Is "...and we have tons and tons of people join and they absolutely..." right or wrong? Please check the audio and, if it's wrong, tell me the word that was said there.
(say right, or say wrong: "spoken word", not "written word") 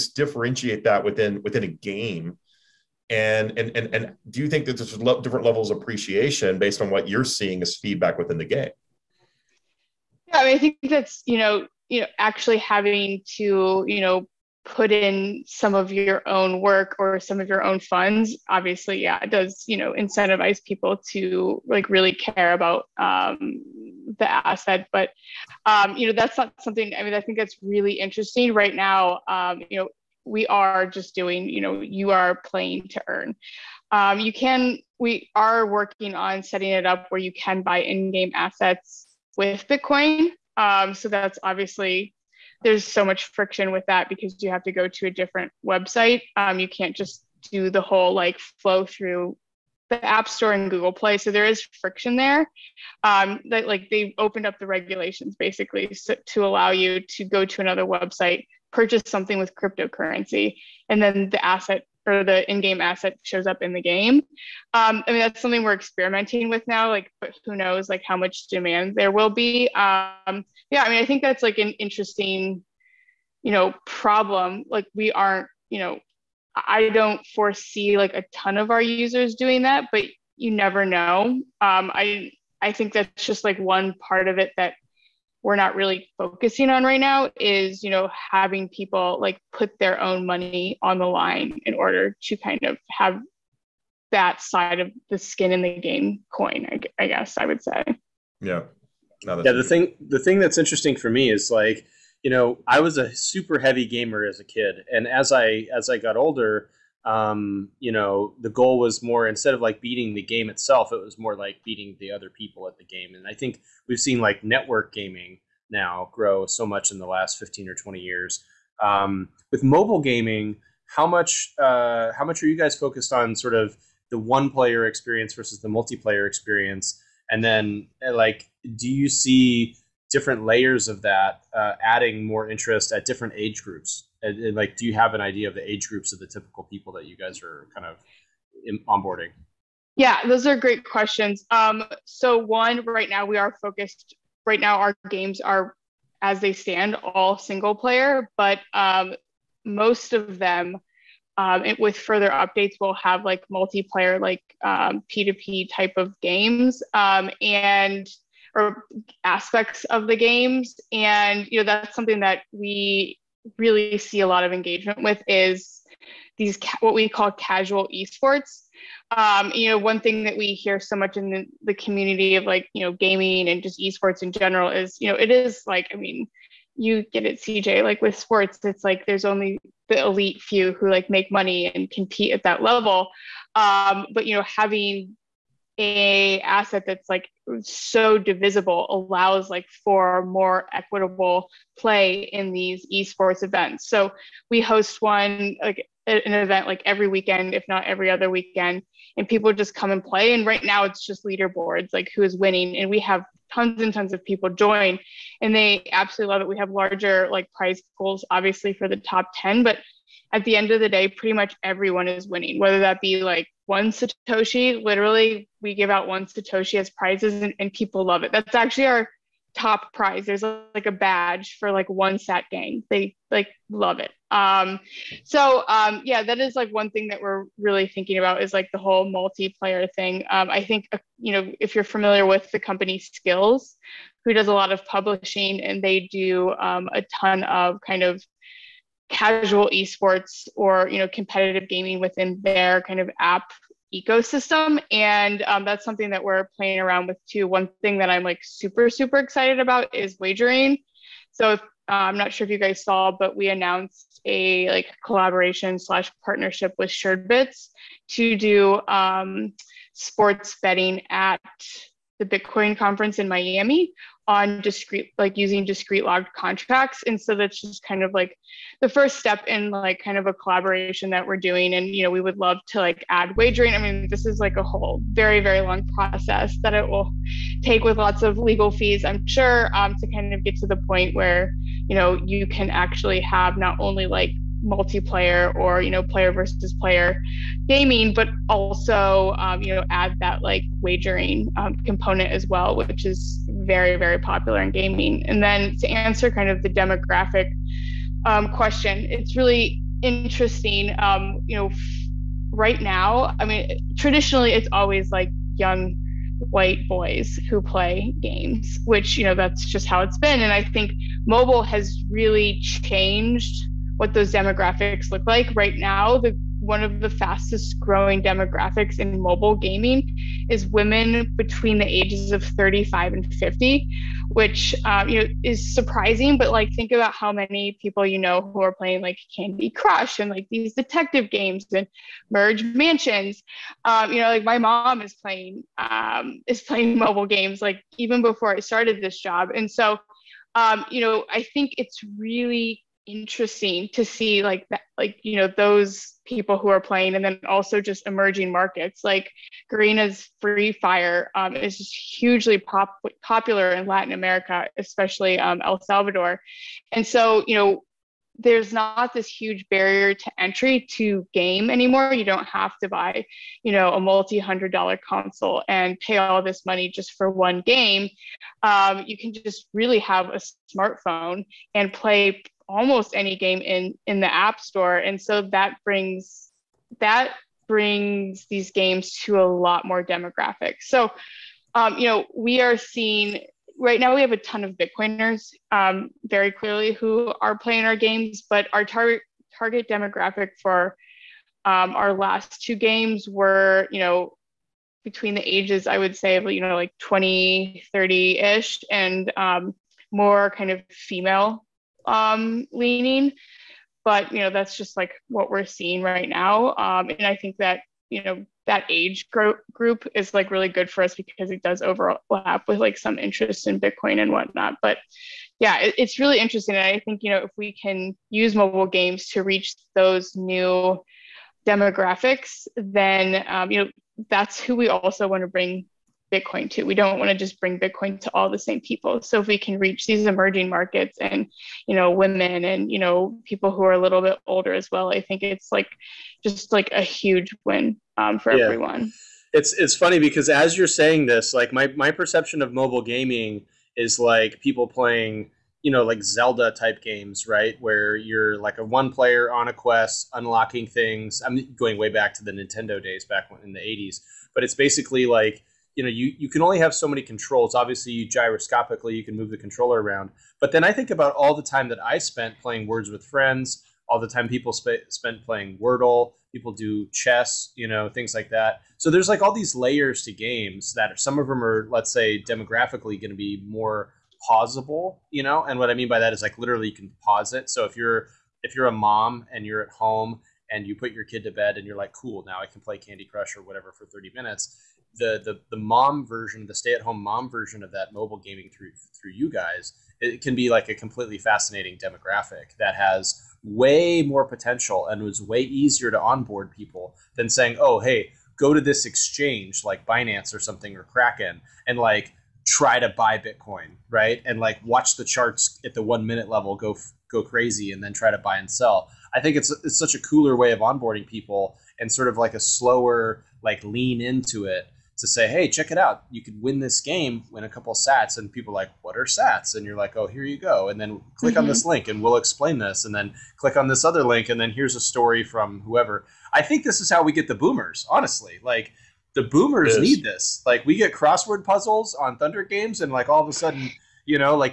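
right.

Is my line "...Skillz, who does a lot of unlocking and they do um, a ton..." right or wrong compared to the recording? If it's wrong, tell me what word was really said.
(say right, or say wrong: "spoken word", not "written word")
wrong: "publishing", not "unlocking".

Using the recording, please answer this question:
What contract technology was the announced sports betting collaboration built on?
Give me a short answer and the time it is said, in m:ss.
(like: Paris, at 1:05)
discrete log contracts, at 4:25.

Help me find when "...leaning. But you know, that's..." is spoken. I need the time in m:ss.
6:42.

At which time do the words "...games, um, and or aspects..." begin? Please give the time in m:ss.
2:36.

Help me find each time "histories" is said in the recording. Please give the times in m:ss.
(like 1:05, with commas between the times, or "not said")
not said.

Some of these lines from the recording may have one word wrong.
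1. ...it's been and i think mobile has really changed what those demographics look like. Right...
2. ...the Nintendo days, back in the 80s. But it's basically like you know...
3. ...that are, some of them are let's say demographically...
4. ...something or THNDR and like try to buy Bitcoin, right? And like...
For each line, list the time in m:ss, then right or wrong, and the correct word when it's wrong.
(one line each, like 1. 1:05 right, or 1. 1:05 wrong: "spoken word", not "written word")
1. 5:10 right
2. 7:32 right
3. 7:50 right
4. 8:20 wrong: "Kraken", not "THNDR".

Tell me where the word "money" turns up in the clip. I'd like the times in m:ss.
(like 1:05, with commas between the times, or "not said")
1:30, 3:01, 6:06.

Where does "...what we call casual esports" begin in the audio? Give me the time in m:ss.
2:46.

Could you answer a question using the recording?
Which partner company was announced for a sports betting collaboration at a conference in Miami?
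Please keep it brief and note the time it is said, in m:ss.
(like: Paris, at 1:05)
Suredbits, at 4:16.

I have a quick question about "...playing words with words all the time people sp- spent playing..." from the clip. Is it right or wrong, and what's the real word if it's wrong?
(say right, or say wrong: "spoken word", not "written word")
wrong: "friends", not "words".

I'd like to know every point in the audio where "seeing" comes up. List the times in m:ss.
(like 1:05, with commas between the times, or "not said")
0:07, 6:22, 6:45.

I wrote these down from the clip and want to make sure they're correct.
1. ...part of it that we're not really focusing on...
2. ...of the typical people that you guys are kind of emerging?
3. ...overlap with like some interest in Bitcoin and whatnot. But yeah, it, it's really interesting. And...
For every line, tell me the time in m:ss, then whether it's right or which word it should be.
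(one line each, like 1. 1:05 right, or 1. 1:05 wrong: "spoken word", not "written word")
1. 1:24 right
2. 2:16 wrong: "onboarding", not "emerging"
3. 6:51 right.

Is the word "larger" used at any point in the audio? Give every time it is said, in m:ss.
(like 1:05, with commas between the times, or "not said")
3:26.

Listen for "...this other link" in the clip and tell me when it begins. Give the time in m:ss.
8:43.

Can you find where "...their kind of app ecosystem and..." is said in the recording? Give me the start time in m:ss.
4:02.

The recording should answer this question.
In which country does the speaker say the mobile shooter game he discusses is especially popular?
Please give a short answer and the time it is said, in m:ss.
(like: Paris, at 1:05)
El Salvador, at 5:55.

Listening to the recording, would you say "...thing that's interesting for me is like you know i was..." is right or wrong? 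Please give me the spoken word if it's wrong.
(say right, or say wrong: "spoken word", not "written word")
right.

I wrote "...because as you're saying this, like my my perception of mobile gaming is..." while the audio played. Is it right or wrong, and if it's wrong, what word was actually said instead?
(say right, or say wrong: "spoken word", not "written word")
right.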